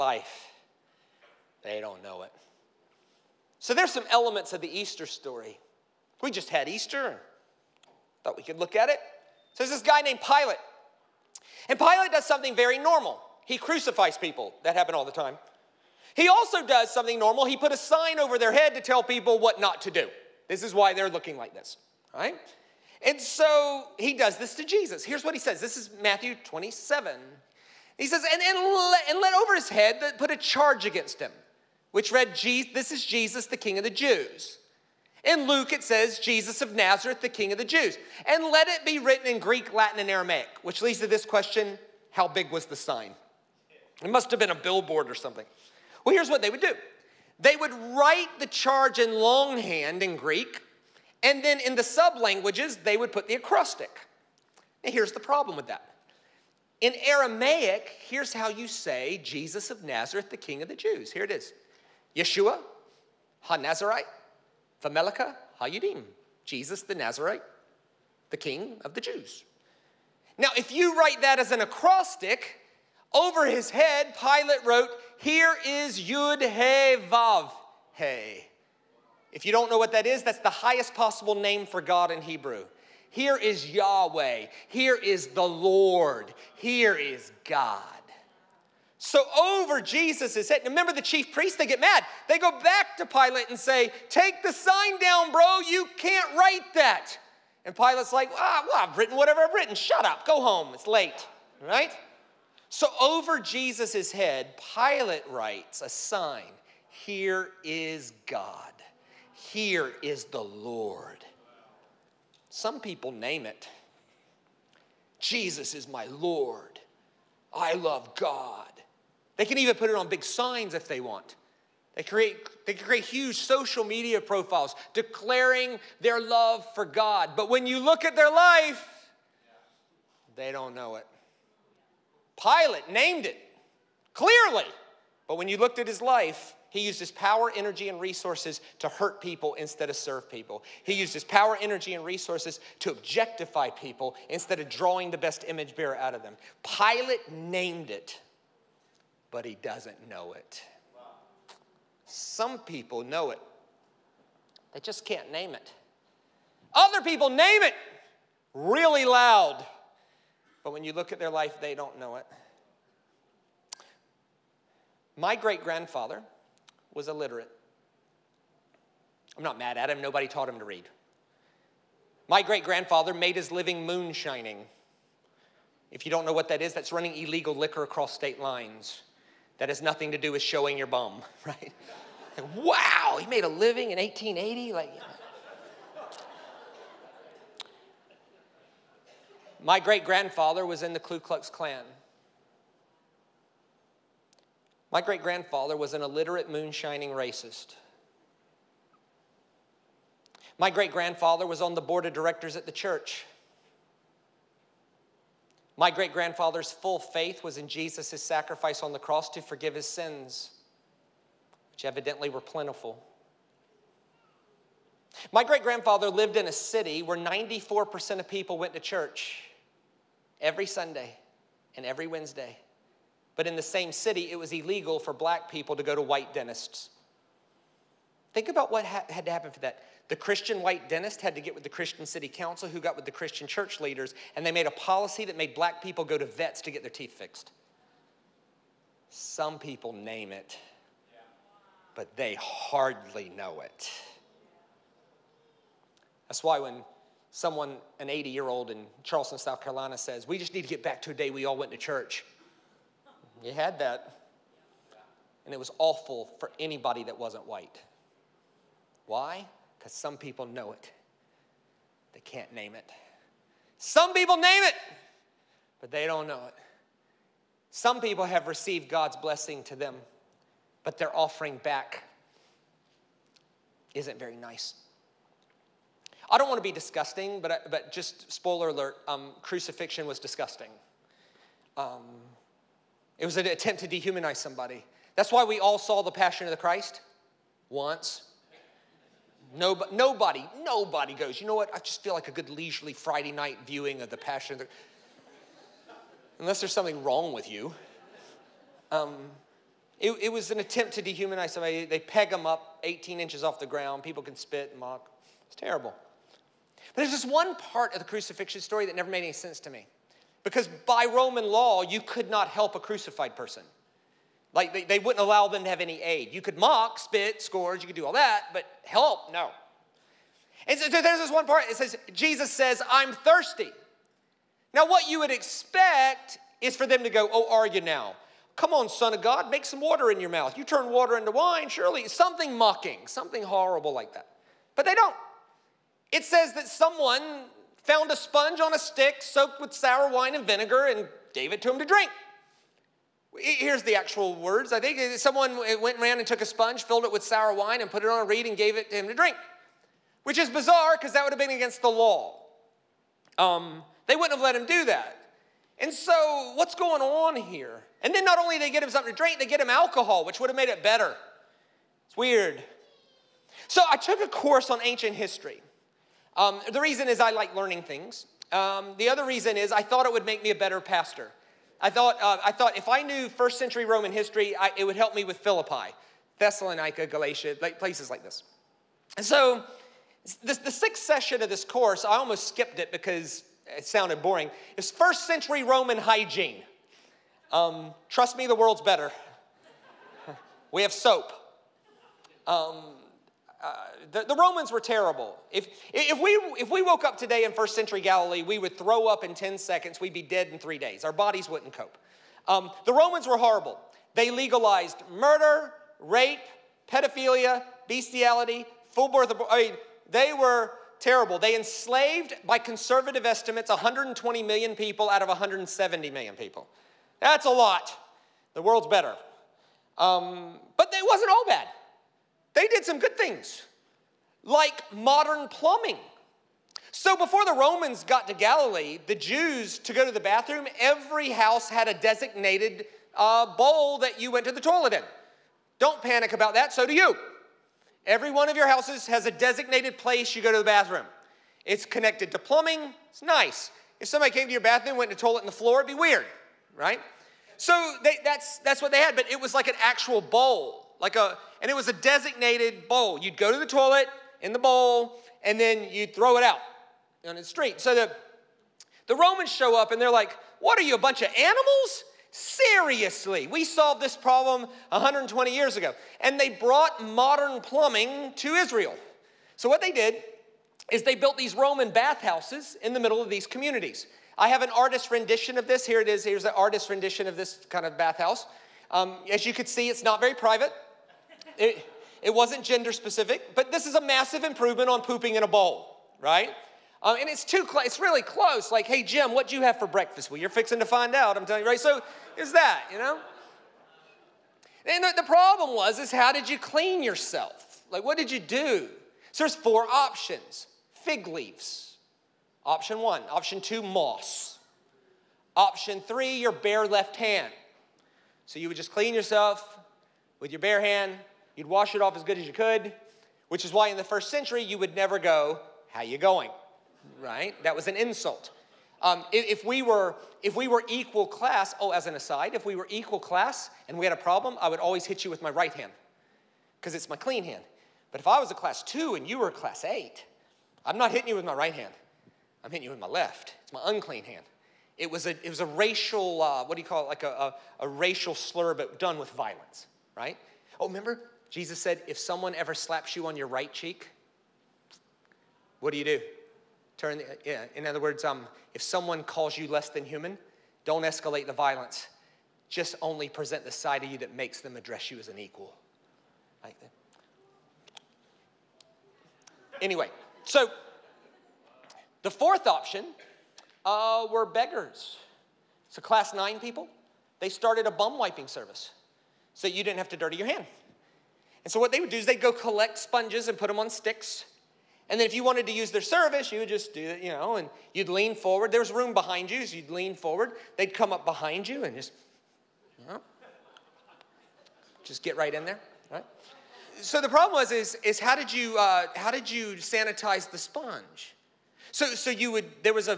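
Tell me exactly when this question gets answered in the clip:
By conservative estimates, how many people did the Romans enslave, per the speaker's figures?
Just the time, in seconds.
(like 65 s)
413 s.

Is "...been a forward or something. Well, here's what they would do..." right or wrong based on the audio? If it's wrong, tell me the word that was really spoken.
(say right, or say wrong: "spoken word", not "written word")
wrong: "billboard", not "forward".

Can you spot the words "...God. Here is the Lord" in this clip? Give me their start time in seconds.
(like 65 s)
108 s.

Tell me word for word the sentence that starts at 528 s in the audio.
But if I was a class two and you were a class eight, I'm not hitting you with my right hand.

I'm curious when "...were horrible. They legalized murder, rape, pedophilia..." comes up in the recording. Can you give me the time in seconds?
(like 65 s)
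403 s.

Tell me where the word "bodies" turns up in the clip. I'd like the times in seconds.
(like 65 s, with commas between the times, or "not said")
401 s.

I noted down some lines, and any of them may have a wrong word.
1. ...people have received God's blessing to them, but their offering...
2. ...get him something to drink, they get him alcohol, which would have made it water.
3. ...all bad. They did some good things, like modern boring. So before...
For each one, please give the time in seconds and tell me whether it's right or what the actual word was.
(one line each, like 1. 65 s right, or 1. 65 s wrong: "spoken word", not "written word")
1. 268 s right
2. 358 s wrong: "better", not "water"
3. 421 s wrong: "plumbing", not "boring".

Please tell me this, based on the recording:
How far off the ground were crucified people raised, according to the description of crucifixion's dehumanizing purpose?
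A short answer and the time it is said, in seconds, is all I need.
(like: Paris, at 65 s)
18 inches, at 302 s.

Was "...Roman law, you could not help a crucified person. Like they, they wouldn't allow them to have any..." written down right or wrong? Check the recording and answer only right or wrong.
right.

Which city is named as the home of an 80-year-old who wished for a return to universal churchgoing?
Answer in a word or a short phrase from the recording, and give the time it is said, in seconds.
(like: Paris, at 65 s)
Charleston, South Carolina, at 249 s.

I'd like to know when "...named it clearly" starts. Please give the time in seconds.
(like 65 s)
132 s.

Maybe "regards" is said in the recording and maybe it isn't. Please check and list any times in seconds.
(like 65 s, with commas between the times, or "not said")
not said.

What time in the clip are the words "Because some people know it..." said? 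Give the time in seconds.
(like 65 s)
259 s.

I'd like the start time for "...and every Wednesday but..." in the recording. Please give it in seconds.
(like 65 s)
221 s.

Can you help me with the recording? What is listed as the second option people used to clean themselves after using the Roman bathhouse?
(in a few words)
Moss.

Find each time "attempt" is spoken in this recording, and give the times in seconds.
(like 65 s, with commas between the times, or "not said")
283 s, 300 s.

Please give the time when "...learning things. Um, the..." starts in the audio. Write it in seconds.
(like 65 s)
367 s.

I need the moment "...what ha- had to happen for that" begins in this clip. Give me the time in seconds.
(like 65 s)
228 s.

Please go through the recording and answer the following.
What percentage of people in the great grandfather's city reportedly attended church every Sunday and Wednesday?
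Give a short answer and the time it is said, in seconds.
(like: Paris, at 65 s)
94%, at 217 s.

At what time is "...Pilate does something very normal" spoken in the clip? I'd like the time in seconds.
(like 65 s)
11 s.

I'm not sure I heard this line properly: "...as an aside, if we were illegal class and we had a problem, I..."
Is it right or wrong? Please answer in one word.
wrong.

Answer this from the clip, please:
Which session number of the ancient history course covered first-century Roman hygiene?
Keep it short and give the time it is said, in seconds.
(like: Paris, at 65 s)
Sixth, at 380 s.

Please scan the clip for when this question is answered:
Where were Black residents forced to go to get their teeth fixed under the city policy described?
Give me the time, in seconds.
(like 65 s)
236 s.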